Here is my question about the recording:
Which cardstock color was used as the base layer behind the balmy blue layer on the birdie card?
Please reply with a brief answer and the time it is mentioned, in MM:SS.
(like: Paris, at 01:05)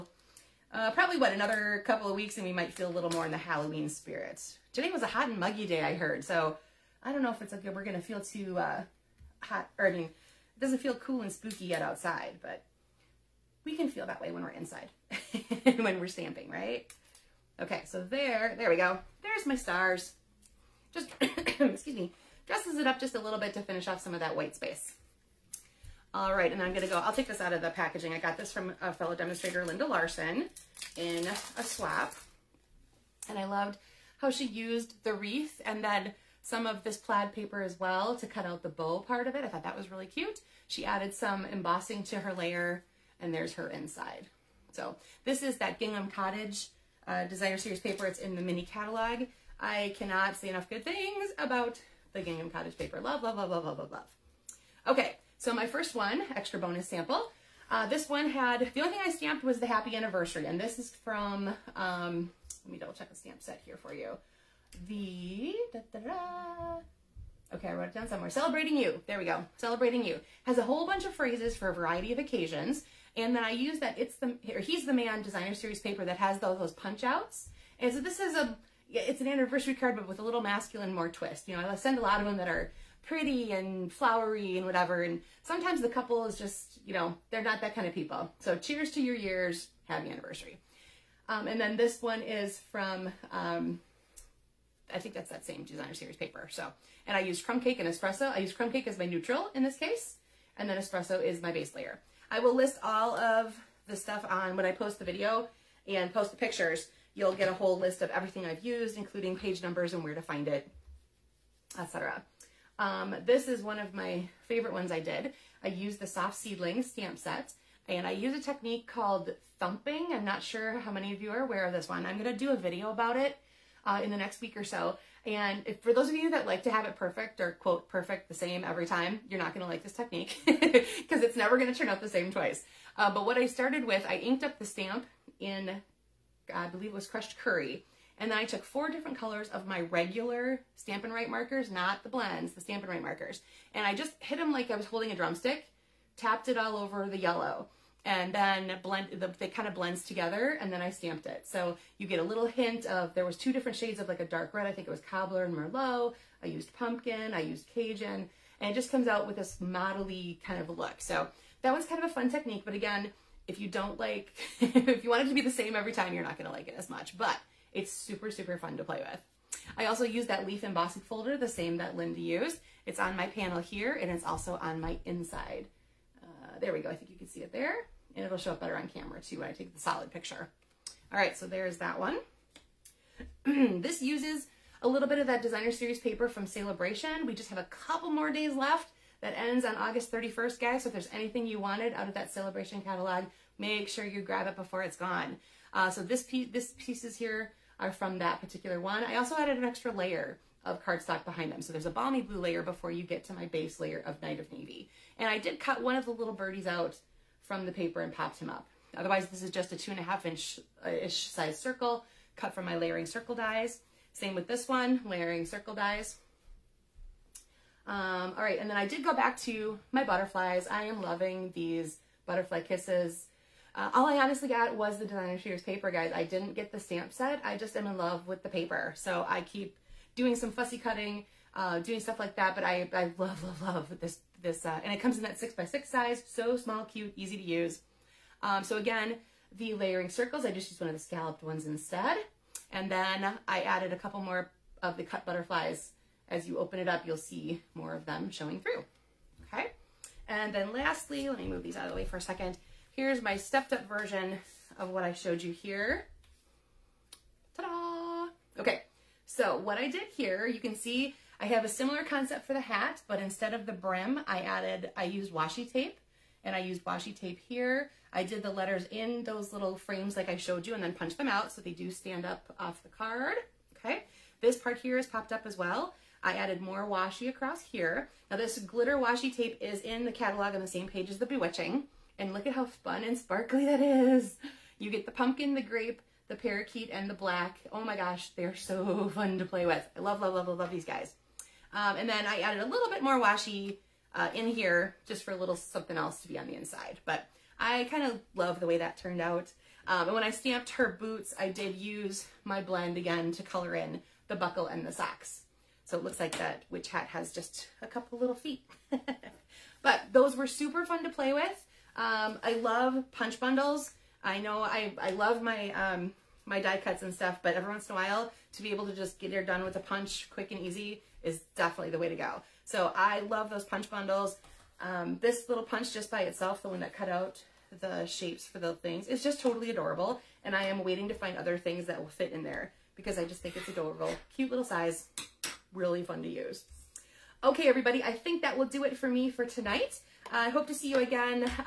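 Night of Navy, at 03:24.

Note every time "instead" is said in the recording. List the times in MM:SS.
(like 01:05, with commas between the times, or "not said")
04:01, 04:23.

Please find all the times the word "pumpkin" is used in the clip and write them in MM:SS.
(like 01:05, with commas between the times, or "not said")
02:36, 04:45.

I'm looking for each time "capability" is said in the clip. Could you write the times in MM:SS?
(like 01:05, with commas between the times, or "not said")
not said.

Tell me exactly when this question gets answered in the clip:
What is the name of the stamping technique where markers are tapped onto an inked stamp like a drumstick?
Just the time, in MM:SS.
01:59.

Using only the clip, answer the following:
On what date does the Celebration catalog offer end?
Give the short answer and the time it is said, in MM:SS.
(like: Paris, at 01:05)
August 31st, at 03:09.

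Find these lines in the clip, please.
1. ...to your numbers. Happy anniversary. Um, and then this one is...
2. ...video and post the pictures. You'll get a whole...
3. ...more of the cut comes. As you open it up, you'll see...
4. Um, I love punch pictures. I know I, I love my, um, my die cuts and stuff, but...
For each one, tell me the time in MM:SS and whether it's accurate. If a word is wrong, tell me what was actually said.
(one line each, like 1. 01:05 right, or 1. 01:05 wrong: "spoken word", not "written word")
1. 01:28 wrong: "years", not "numbers"
2. 01:45 right
3. 04:04 wrong: "butterflies", not "comes"
4. 05:11 wrong: "bundles", not "pictures".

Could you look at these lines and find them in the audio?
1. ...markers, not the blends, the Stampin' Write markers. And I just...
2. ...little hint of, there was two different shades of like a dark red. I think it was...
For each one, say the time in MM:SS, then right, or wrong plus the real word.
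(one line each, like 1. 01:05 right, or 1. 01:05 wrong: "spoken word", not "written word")
1. 02:21 right
2. 02:32 right.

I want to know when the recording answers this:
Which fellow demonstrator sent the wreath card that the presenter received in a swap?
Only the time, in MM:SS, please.
00:29.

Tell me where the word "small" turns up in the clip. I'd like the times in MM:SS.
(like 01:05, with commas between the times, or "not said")
03:56.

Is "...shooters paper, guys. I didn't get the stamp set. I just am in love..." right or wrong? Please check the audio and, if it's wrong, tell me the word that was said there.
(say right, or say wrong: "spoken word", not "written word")
right.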